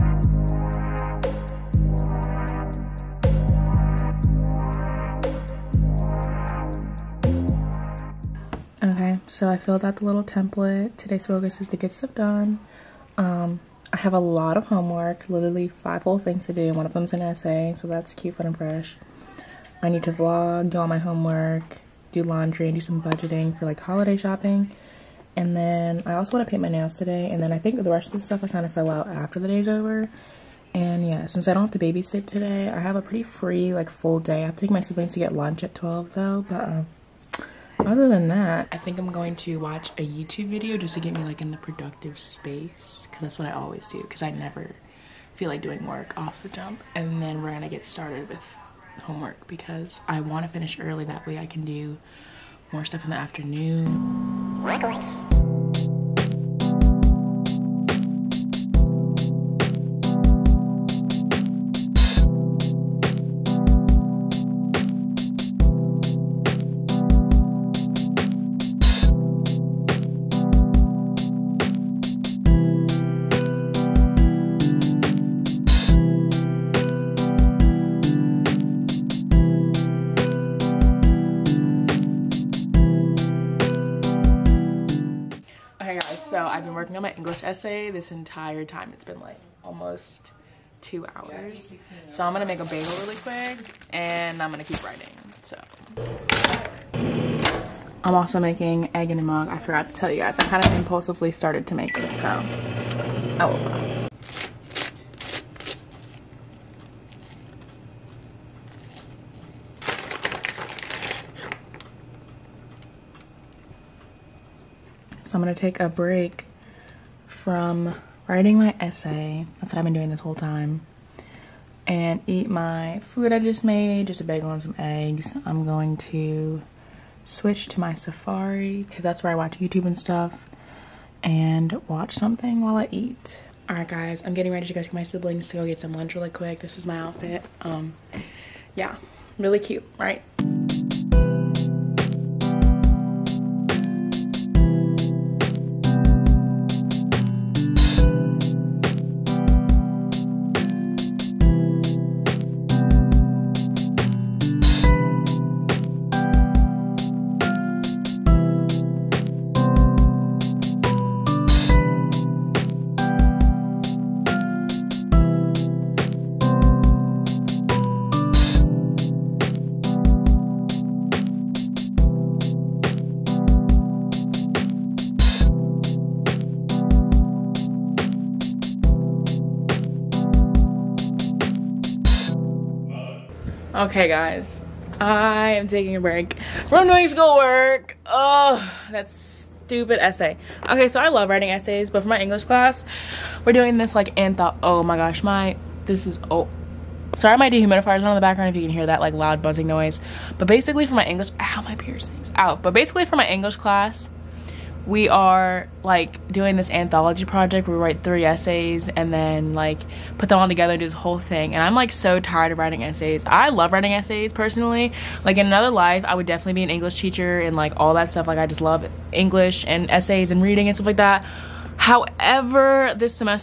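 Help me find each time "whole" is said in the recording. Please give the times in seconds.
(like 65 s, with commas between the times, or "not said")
16 s, 120 s, 210 s.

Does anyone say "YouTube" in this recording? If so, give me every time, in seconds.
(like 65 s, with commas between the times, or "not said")
40 s, 129 s.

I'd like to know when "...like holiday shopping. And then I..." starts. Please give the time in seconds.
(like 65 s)
23 s.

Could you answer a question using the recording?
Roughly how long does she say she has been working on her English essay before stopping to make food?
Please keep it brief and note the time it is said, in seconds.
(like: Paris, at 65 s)
almost two hours, at 89 s.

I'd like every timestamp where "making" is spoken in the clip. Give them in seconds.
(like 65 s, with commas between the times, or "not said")
98 s.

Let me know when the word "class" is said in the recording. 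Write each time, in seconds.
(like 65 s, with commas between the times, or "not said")
192 s, 203 s.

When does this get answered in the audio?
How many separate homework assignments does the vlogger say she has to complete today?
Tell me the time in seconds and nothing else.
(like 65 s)
15 s.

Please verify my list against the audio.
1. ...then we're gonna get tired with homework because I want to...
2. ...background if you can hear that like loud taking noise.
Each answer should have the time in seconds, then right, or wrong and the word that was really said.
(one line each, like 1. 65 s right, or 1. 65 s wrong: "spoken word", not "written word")
1. 47 s wrong: "started", not "tired"
2. 198 s wrong: "buzzing", not "taking".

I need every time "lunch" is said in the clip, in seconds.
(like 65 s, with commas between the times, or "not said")
35 s, 135 s.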